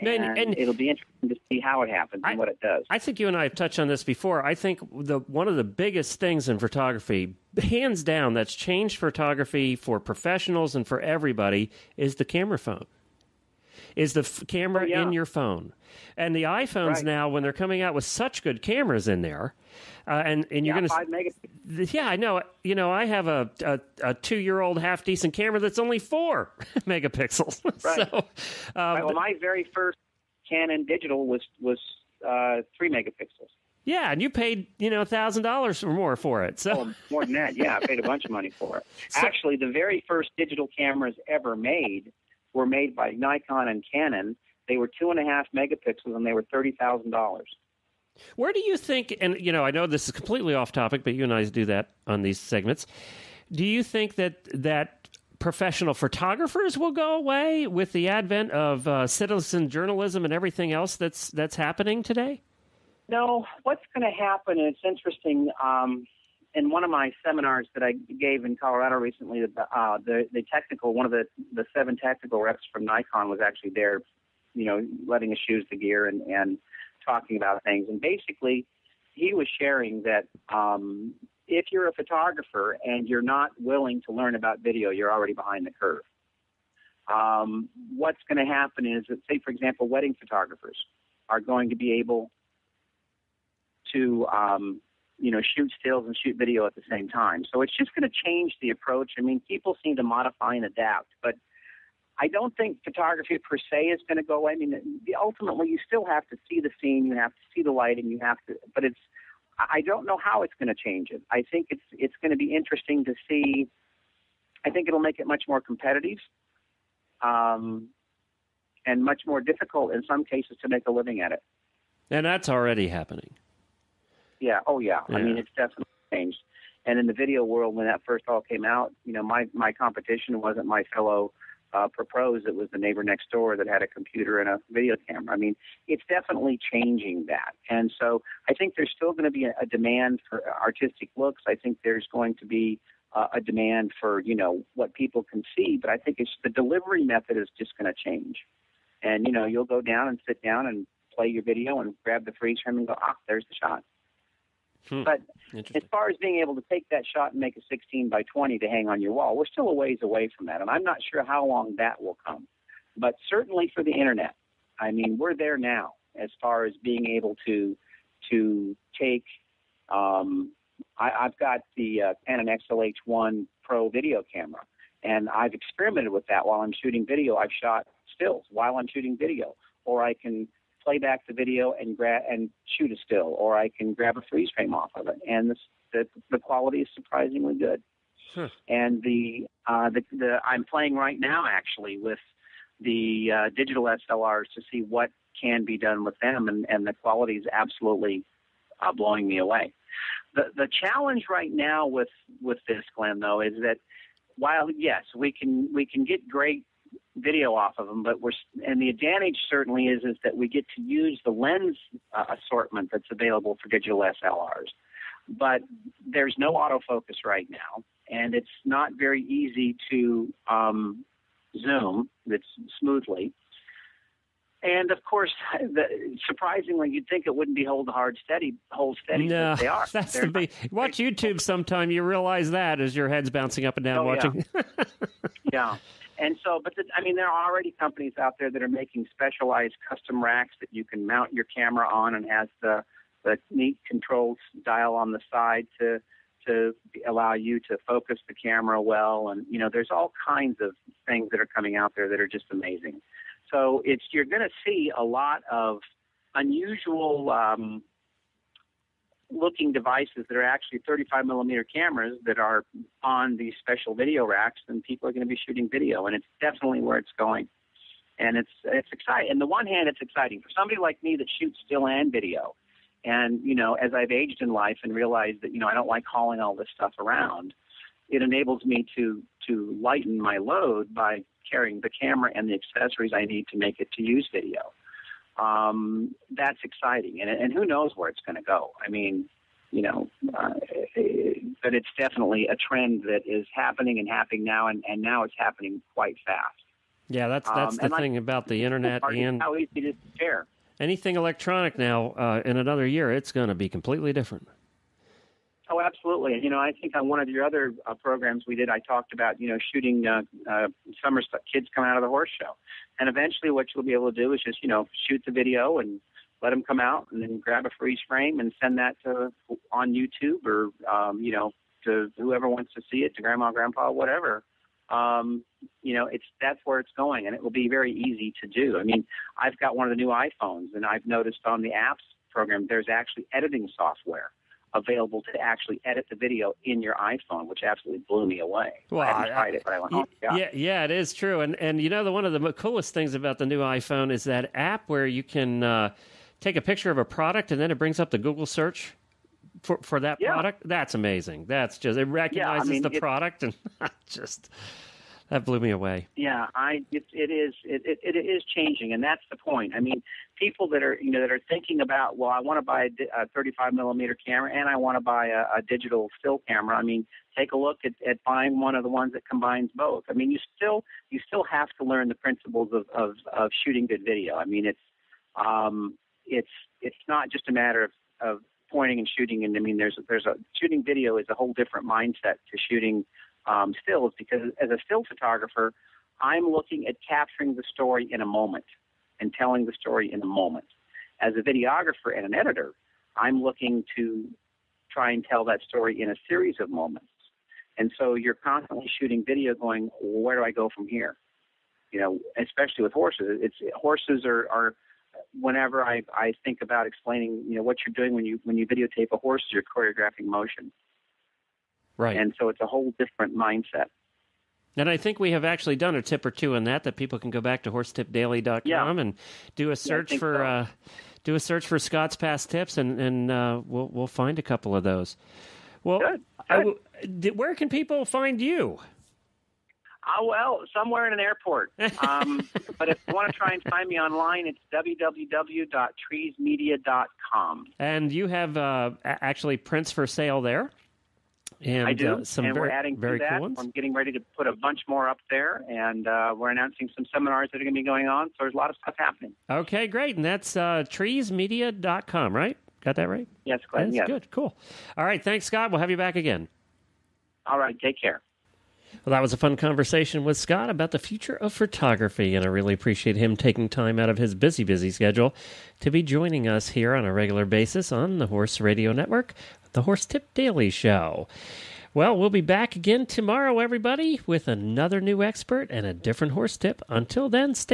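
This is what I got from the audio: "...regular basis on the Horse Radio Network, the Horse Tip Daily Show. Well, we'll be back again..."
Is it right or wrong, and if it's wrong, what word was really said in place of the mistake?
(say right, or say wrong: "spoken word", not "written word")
right.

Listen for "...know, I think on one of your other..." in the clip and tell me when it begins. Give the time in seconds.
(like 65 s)
306 s.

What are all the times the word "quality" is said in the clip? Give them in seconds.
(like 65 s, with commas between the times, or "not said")
186 s, 196 s.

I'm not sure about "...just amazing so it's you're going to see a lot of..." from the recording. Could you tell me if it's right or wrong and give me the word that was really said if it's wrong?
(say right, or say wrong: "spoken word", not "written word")
right.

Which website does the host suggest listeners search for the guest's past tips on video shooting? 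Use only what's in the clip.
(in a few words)
horsetipdaily.com.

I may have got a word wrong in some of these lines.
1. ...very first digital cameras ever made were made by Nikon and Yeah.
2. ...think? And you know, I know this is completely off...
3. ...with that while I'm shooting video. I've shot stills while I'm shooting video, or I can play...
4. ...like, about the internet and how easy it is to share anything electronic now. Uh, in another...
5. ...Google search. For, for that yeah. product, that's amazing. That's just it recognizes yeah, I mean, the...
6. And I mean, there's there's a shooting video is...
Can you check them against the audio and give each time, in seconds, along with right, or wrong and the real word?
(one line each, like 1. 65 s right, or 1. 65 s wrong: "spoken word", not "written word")
1. 39 s wrong: "Canon", not "Yeah"
2. 48 s right
3. 176 s right
4. 298 s right
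5. 348 s right
6. 379 s right.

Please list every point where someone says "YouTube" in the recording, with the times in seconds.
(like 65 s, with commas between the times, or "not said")
230 s, 319 s.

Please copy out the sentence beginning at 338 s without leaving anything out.
Well, I I, tried it, but I went, oh, yeah.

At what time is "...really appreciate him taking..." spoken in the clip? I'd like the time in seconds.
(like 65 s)
462 s.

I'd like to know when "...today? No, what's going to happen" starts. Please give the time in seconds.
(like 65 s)
62 s.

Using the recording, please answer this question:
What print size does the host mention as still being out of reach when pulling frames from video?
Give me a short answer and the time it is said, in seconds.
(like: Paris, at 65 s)
16 by 20, at 157 s.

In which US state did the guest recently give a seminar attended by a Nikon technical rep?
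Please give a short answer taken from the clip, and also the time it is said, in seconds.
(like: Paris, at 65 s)
Colorado, at 68 s.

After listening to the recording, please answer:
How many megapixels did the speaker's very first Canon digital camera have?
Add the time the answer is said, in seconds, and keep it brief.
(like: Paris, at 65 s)
3, at 32 s.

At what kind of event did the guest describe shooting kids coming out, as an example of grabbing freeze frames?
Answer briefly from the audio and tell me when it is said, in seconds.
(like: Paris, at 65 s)
horse show, at 312 s.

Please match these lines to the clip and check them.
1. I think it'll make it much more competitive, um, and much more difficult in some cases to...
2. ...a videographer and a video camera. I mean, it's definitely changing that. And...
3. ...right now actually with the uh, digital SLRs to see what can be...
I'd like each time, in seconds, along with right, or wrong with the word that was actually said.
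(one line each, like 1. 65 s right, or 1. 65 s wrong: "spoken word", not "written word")
1. 114 s right
2. 133 s wrong: "computer", not "videographer"
3. 190 s right.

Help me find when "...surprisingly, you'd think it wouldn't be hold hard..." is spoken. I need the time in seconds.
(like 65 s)
226 s.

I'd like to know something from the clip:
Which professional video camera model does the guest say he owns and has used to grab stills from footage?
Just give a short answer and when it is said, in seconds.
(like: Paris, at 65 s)
Canon XLH1, at 172 s.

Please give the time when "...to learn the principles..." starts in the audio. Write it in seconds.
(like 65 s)
371 s.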